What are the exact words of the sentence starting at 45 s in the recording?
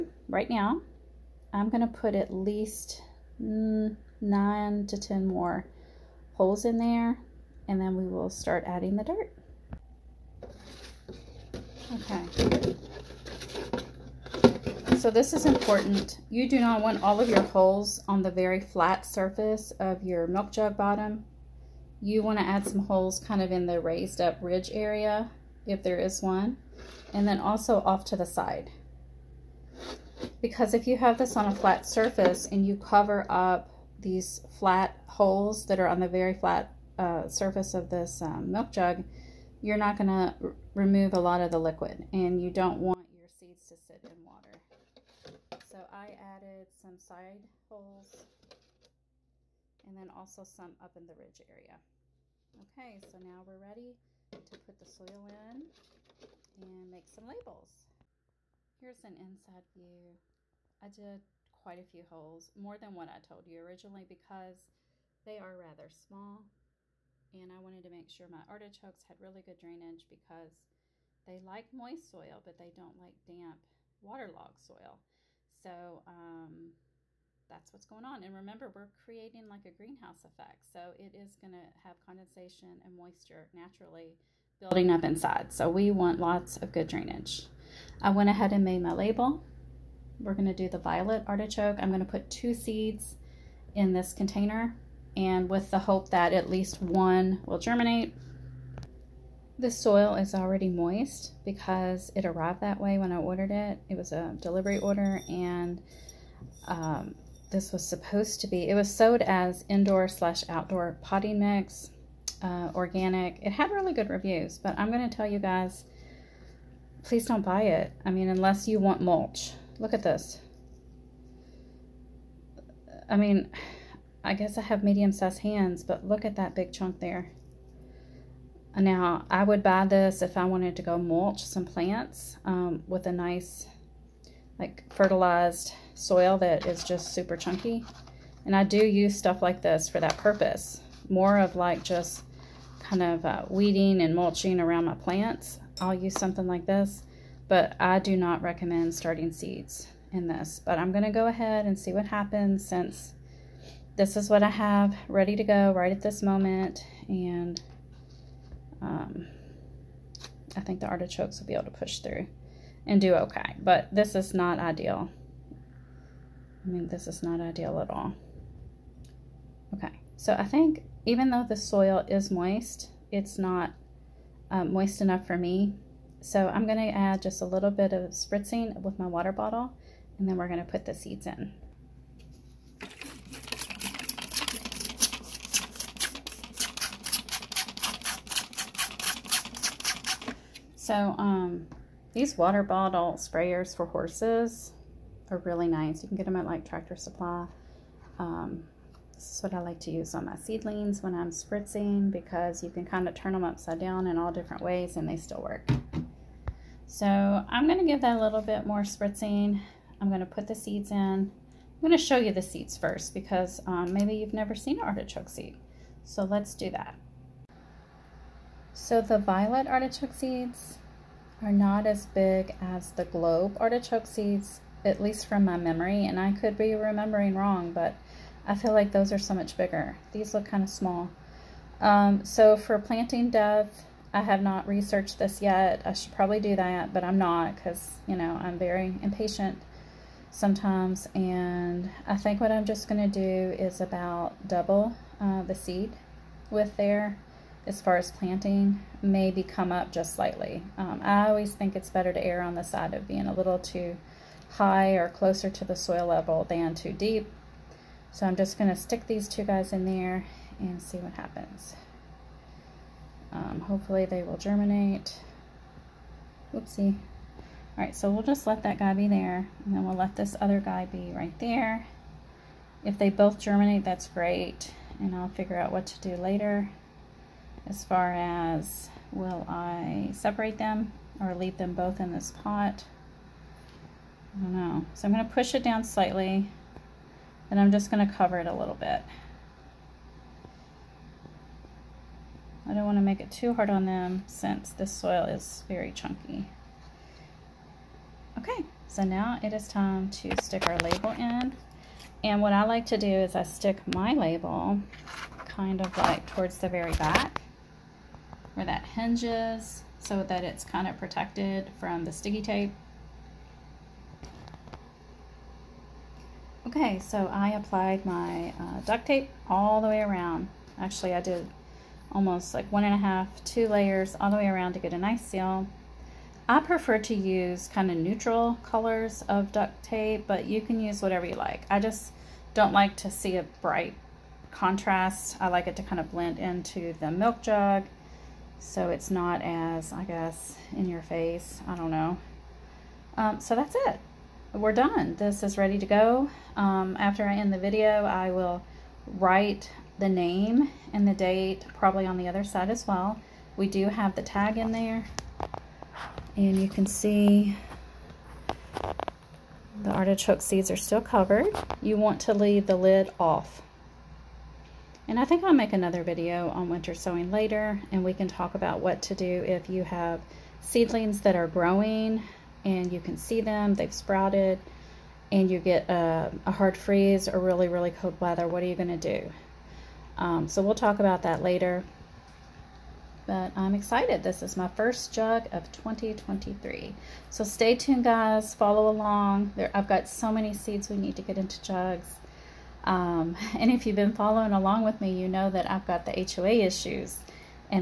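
So I added some side holes and then also some up in the ridge area.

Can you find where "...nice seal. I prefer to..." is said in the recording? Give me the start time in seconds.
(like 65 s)
324 s.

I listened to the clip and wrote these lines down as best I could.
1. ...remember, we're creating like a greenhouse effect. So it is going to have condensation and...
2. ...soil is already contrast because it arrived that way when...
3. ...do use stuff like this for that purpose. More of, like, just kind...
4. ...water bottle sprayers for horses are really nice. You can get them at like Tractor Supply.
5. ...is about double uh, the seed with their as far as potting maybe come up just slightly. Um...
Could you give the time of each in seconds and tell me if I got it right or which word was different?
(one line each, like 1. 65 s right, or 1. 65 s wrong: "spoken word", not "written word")
1. 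78 s right
2. 99 s wrong: "moist", not "contrast"
3. 138 s right
4. 192 s right
5. 243 s wrong: "planting", not "potting".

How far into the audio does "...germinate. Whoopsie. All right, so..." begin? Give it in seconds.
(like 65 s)
264 s.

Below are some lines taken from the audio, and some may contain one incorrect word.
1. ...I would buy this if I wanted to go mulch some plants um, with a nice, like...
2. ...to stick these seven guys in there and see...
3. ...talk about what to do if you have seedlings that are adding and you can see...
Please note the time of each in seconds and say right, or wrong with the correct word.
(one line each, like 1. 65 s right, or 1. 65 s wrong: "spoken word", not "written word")
1. 129 s right
2. 258 s wrong: "two", not "seven"
3. 368 s wrong: "growing", not "adding".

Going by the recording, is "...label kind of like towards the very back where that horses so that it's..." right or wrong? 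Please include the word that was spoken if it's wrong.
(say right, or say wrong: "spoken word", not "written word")
wrong: "hinges", not "horses".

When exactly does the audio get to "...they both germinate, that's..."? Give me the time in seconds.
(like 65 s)
272 s.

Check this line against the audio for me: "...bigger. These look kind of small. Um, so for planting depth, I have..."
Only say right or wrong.
right.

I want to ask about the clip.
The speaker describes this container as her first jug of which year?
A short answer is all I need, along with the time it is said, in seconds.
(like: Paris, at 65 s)
2023, at 385 s.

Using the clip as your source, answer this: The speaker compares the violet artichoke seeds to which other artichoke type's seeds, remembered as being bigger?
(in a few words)
Globe artichoke.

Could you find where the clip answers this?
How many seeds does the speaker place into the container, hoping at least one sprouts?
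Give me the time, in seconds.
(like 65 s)
92 s.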